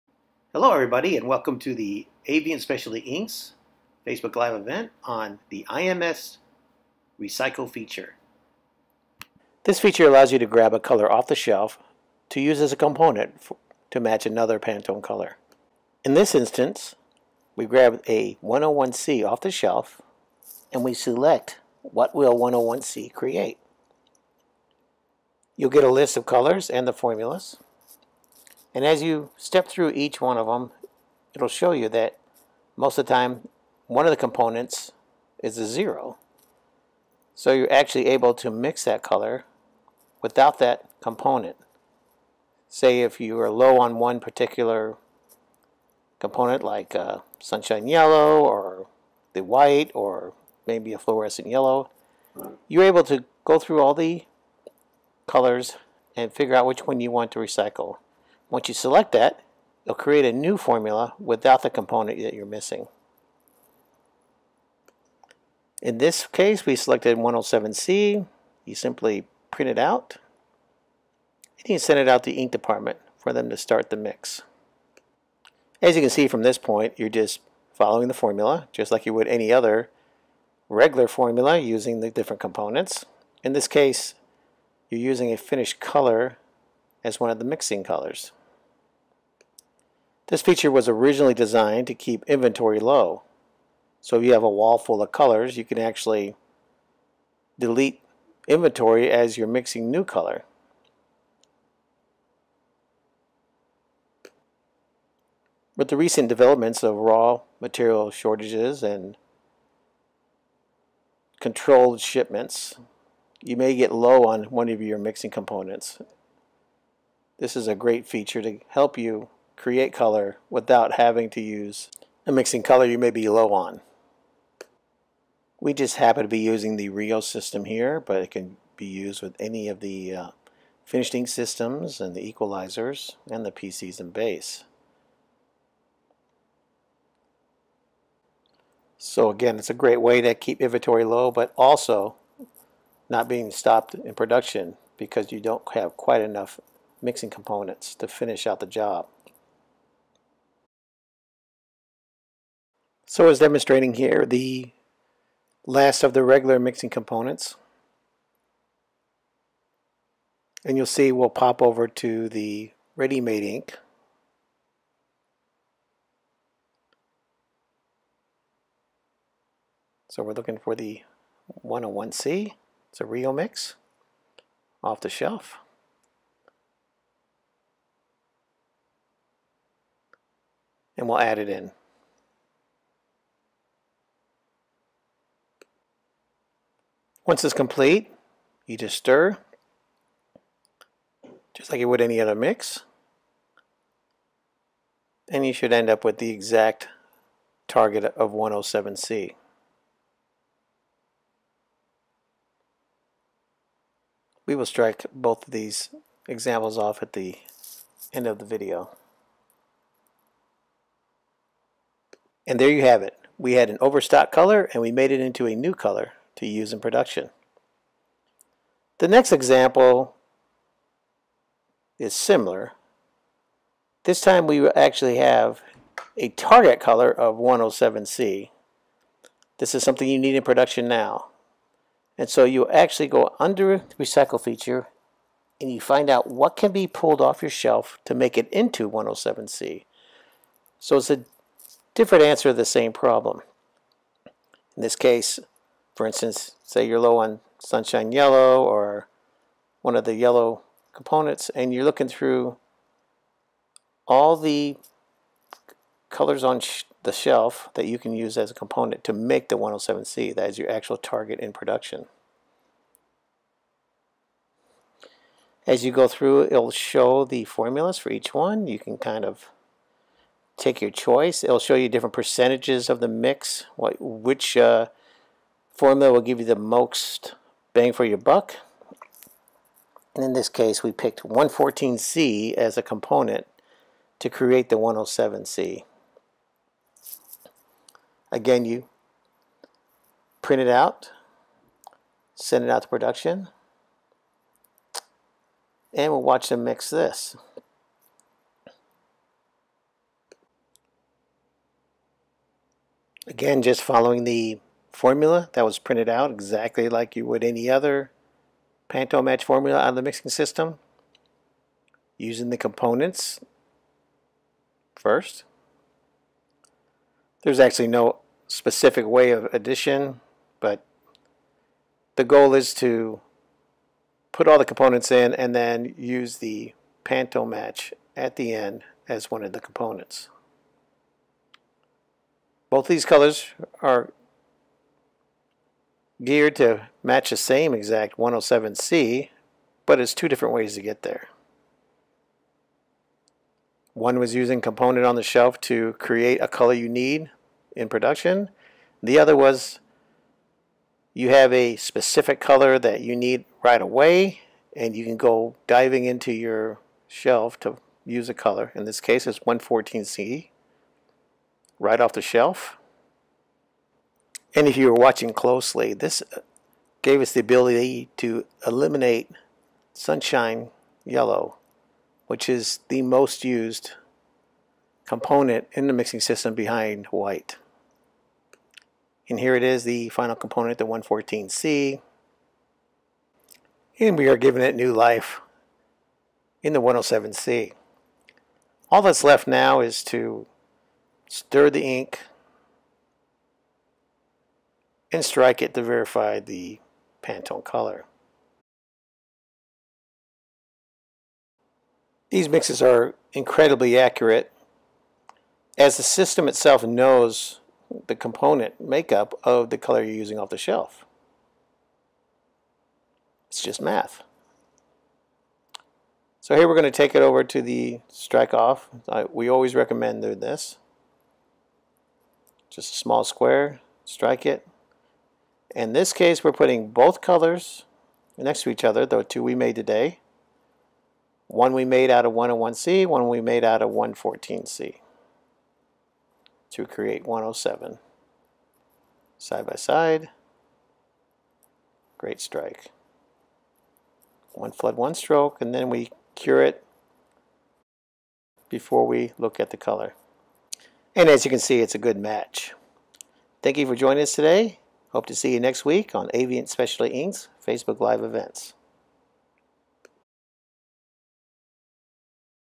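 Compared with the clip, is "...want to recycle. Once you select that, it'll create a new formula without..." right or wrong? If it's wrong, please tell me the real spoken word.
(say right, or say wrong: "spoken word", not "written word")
right.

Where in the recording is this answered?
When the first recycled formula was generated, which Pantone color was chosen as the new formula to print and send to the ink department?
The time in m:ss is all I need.
1:05.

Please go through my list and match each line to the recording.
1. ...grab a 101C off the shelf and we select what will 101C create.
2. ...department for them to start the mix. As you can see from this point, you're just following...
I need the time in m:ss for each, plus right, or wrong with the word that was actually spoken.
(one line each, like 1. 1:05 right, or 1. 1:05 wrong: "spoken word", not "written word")
1. 0:17 right
2. 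1:12 right.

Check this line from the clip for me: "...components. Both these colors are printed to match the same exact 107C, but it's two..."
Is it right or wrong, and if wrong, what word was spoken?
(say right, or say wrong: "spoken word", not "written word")
wrong: "geared", not "printed".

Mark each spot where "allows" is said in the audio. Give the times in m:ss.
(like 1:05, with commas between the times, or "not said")
0:10.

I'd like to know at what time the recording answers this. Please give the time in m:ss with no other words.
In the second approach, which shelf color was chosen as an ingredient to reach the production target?
4:40.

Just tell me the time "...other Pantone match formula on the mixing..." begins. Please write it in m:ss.
5:07.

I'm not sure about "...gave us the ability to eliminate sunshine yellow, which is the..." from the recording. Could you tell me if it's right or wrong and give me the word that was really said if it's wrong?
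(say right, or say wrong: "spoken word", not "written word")
right.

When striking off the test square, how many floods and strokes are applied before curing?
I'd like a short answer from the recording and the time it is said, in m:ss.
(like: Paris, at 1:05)
One flood, one stroke, at 7:24.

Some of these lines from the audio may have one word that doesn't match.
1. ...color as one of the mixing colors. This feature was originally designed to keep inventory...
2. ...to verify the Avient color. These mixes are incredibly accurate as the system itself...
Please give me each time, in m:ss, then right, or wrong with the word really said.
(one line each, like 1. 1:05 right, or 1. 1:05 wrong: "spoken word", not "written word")
1. 1:25 right
2. 6:35 wrong: "Pantone", not "Avient".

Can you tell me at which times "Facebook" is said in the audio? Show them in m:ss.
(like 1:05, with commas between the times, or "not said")
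0:04, 7:37.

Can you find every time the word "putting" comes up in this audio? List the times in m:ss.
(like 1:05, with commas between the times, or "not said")
7:06.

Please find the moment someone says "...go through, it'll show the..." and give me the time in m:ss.
4:25.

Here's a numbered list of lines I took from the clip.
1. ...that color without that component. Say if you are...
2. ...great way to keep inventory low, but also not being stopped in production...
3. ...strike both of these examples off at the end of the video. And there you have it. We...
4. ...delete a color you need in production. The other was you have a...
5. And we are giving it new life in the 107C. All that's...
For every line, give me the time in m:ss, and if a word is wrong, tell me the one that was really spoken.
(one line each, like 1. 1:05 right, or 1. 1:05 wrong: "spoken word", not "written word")
1. 0:38 right
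2. 2:19 right
3. 3:24 right
4. 5:45 wrong: "create", not "delete"
5. 6:23 right.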